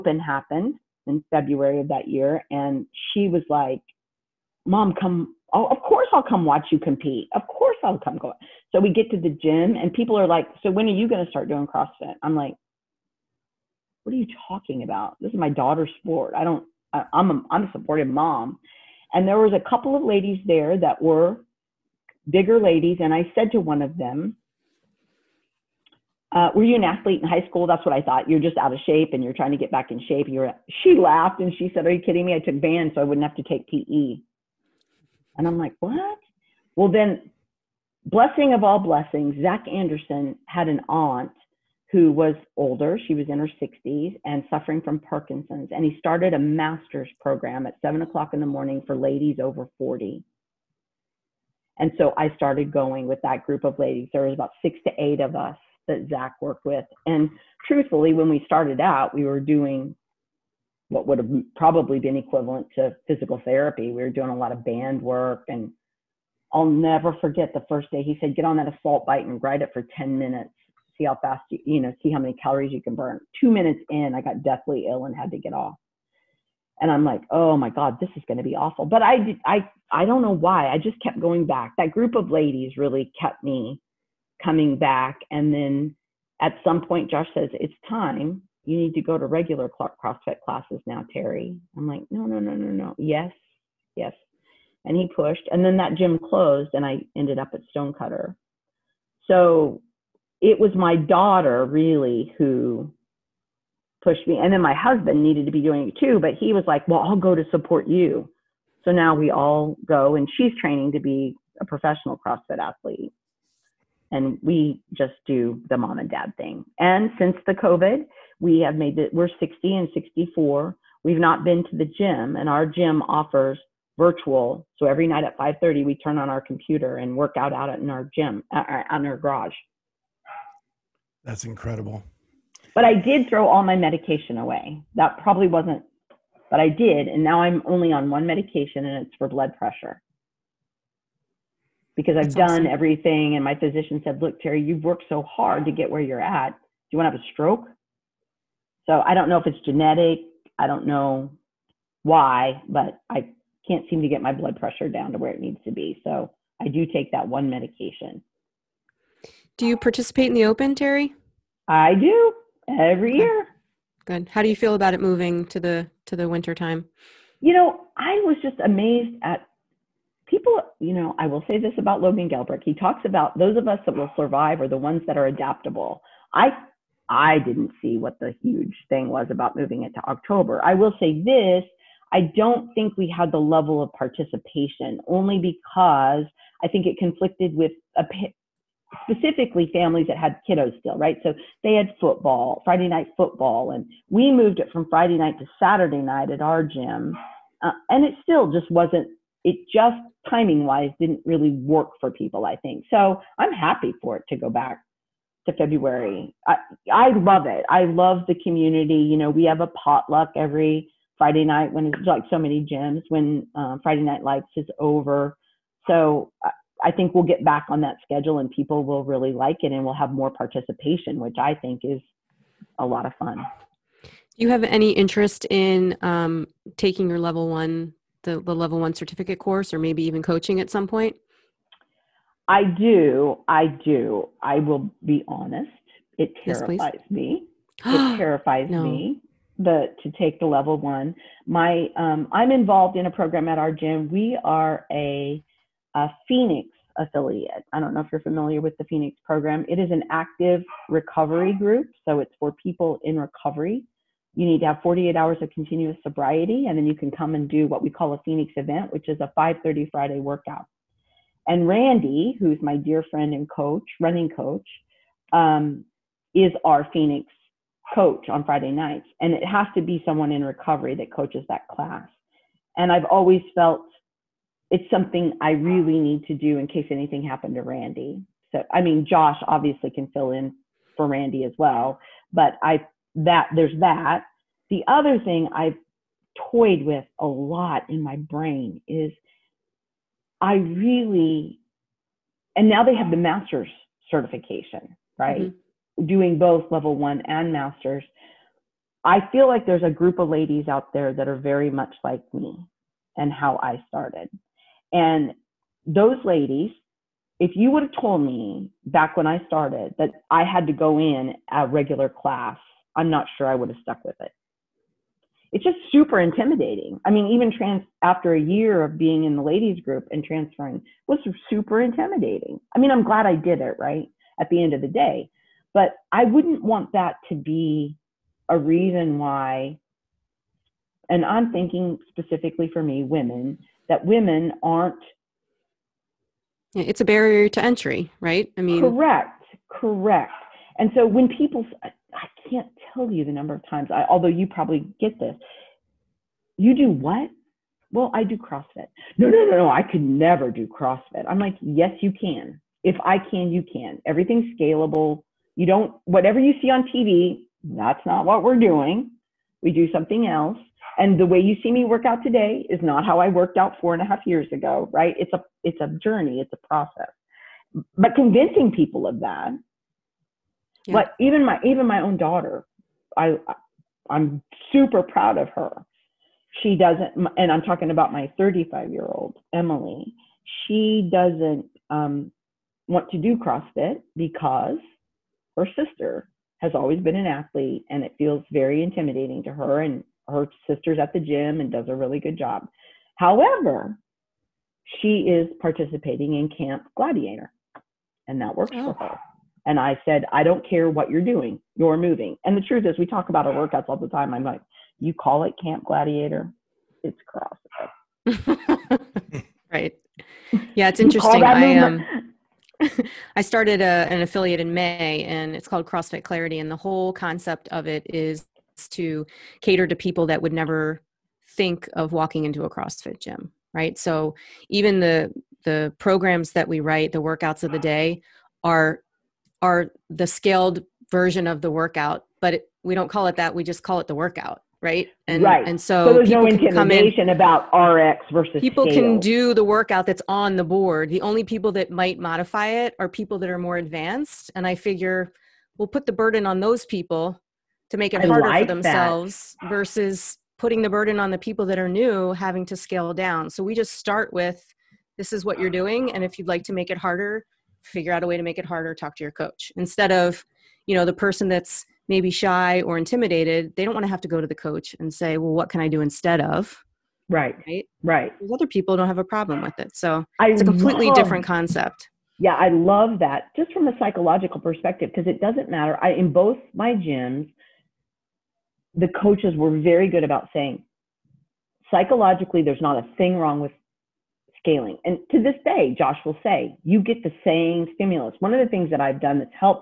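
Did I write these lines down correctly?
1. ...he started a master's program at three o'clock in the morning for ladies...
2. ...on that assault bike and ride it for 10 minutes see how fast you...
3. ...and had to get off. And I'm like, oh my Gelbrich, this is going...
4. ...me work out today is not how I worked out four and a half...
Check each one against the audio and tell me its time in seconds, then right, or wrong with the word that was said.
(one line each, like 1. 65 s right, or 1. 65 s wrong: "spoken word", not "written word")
1. 45 s wrong: "seven", not "three"
2. 68 s right
3. 75 s wrong: "God", not "Gelbrich"
4. 361 s right.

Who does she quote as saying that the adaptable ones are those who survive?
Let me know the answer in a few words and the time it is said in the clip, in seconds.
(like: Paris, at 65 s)
Logan Gelbrich, at 172 s.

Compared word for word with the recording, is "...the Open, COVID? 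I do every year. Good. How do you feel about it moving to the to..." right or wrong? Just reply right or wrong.
wrong.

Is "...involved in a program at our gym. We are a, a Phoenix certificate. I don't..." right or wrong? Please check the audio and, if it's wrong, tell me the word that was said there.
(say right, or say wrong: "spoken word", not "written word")
wrong: "affiliate", not "certificate".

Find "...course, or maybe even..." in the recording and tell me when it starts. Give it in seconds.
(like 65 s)
229 s.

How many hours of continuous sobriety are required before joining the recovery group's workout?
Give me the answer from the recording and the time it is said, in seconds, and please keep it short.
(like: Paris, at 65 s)
48, at 254 s.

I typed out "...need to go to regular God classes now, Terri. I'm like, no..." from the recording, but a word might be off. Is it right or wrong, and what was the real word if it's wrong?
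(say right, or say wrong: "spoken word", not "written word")
wrong: "CrossFit", not "God".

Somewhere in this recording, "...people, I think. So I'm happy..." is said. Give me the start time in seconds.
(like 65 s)
202 s.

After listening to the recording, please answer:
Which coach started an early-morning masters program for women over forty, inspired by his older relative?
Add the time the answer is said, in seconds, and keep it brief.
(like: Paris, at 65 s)
Zach Anderson, at 39 s.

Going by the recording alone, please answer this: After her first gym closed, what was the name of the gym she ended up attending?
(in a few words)
Stonecutter.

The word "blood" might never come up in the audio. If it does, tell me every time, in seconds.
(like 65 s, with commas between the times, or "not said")
139 s, 154 s.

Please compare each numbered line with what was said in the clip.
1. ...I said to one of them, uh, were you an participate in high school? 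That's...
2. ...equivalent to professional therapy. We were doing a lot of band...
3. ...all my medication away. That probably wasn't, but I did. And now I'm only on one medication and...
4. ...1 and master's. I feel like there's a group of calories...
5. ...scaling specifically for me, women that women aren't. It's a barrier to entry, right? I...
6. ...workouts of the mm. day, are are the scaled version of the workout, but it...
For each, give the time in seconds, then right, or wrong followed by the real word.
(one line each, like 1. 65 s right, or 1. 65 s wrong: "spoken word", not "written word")
1. 23 s wrong: "athlete", not "participate"
2. 62 s wrong: "physical", not "professional"
3. 133 s right
4. 296 s wrong: "ladies", not "calories"
5. 331 s wrong: "thinking", not "scaling"
6. 427 s right.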